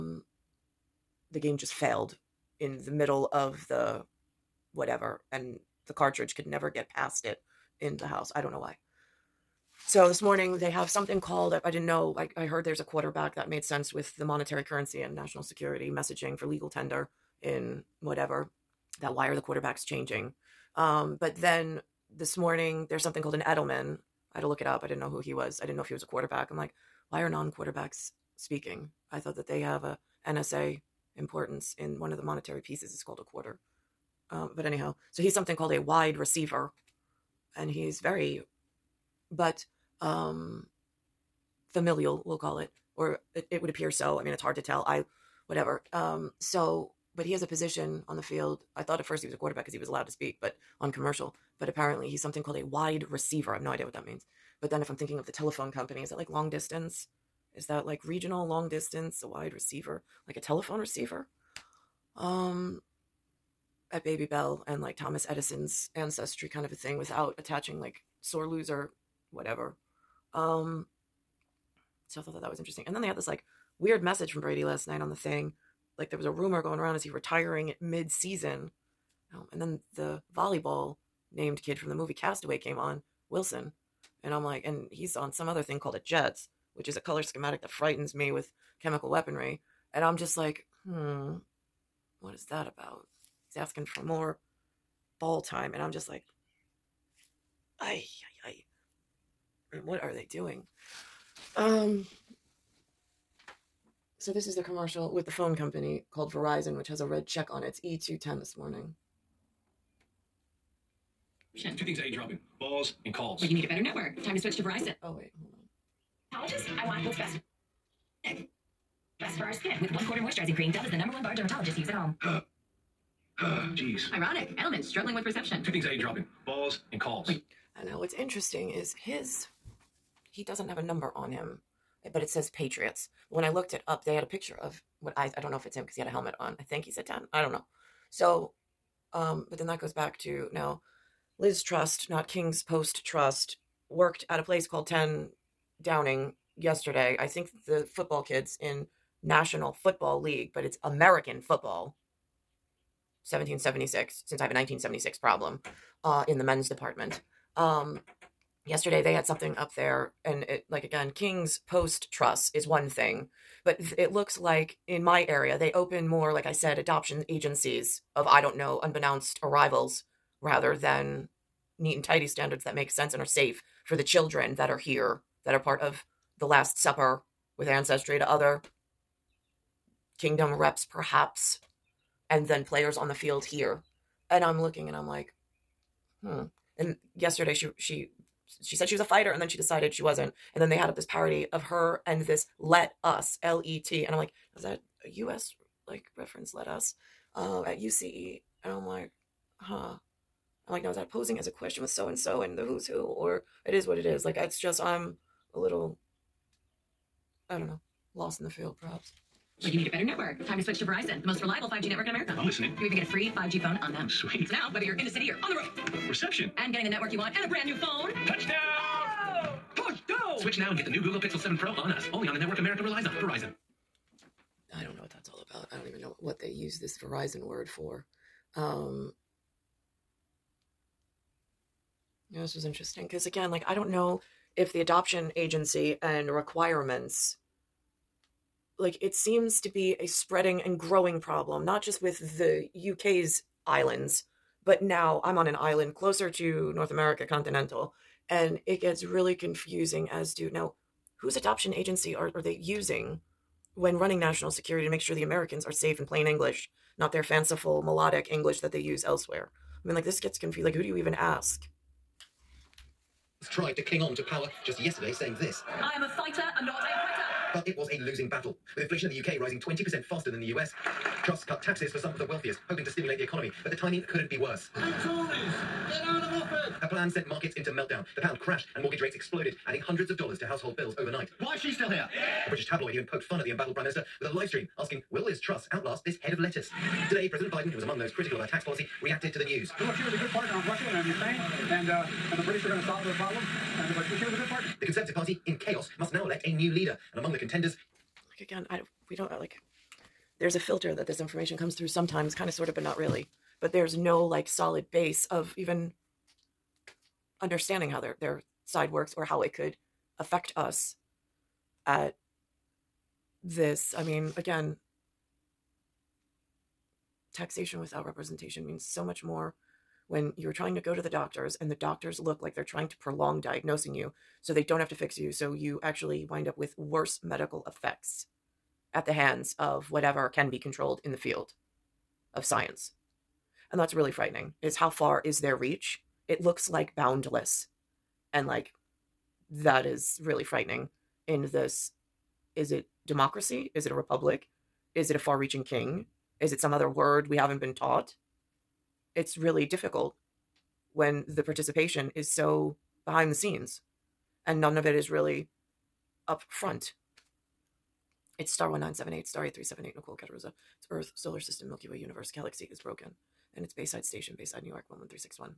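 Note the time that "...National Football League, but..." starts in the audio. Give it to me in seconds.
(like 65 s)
149 s.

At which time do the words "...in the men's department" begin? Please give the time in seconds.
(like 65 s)
156 s.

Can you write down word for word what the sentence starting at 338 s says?
And like that is really frightening in this is it democracy?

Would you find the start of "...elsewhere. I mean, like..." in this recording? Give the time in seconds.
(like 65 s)
259 s.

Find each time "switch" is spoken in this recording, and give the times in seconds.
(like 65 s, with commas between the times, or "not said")
114 s, 210 s, 220 s.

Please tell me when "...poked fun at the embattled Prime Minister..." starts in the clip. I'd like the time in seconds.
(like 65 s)
283 s.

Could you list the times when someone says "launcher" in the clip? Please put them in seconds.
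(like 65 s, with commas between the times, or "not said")
not said.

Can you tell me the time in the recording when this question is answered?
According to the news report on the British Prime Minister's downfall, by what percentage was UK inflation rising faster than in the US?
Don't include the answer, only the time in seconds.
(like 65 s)
269 s.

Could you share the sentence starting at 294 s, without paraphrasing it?
The Conservative Party, in chaos, must now elect a new leader.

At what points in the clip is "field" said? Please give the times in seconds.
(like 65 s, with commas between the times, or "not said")
48 s, 183 s, 208 s, 331 s.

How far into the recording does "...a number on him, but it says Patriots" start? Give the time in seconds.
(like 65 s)
130 s.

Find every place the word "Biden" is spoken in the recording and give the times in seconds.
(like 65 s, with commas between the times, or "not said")
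287 s.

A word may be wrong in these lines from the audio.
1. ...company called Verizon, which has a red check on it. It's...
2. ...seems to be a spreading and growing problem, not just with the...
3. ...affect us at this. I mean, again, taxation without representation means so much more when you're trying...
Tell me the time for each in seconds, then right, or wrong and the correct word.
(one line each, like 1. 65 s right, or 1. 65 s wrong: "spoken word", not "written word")
1. 105 s right
2. 239 s right
3. 310 s right.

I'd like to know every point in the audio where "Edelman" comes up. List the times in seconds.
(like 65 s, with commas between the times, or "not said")
23 s, 124 s.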